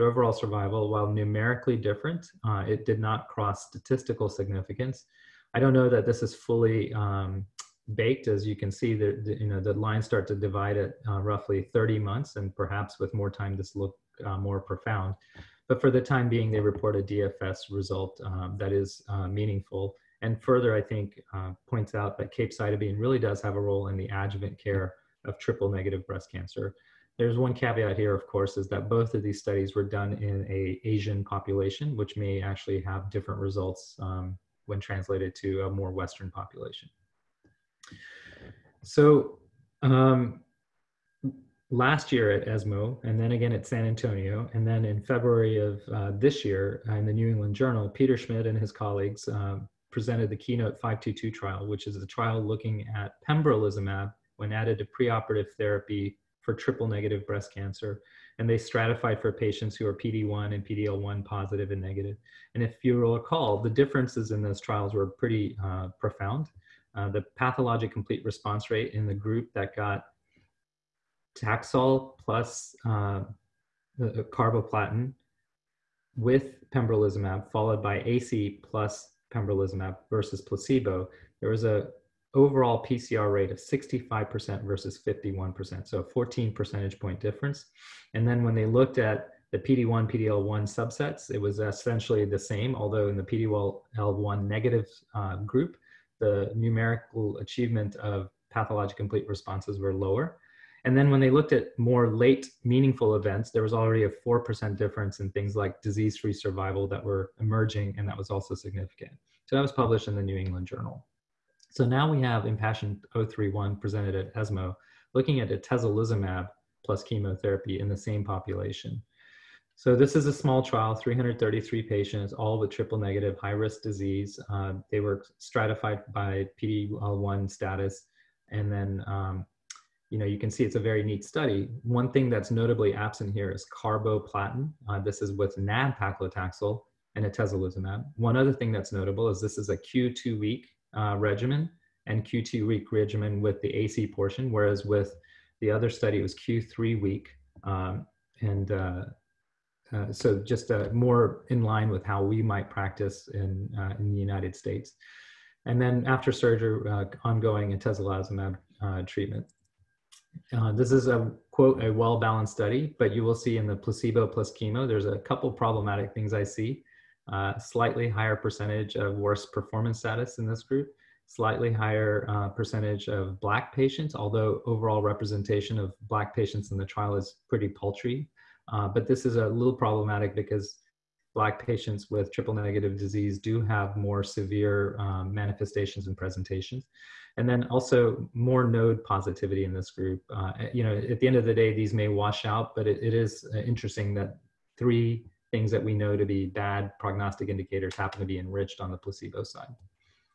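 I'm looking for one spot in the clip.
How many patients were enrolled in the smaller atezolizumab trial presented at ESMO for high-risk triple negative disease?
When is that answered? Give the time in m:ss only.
2:00.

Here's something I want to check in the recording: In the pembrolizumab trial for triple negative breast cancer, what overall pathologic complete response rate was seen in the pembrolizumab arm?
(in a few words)
65%.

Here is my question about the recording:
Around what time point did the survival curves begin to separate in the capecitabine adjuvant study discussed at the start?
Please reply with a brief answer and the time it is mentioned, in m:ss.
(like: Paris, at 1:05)
30 months, at 0:11.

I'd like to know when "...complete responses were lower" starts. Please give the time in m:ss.
1:38.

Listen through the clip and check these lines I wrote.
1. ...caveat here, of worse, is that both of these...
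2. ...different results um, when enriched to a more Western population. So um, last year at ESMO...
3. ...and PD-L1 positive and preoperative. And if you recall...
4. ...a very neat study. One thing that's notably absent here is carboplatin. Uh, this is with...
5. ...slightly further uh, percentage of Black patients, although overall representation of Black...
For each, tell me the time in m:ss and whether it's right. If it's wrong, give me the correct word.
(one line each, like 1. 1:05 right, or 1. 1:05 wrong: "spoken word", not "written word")
1. 0:27 wrong: "course", not "worse"
2. 0:33 wrong: "translated", not "enriched"
3. 1:00 wrong: "negative", not "preoperative"
4. 2:10 right
5. 2:51 wrong: "higher", not "further".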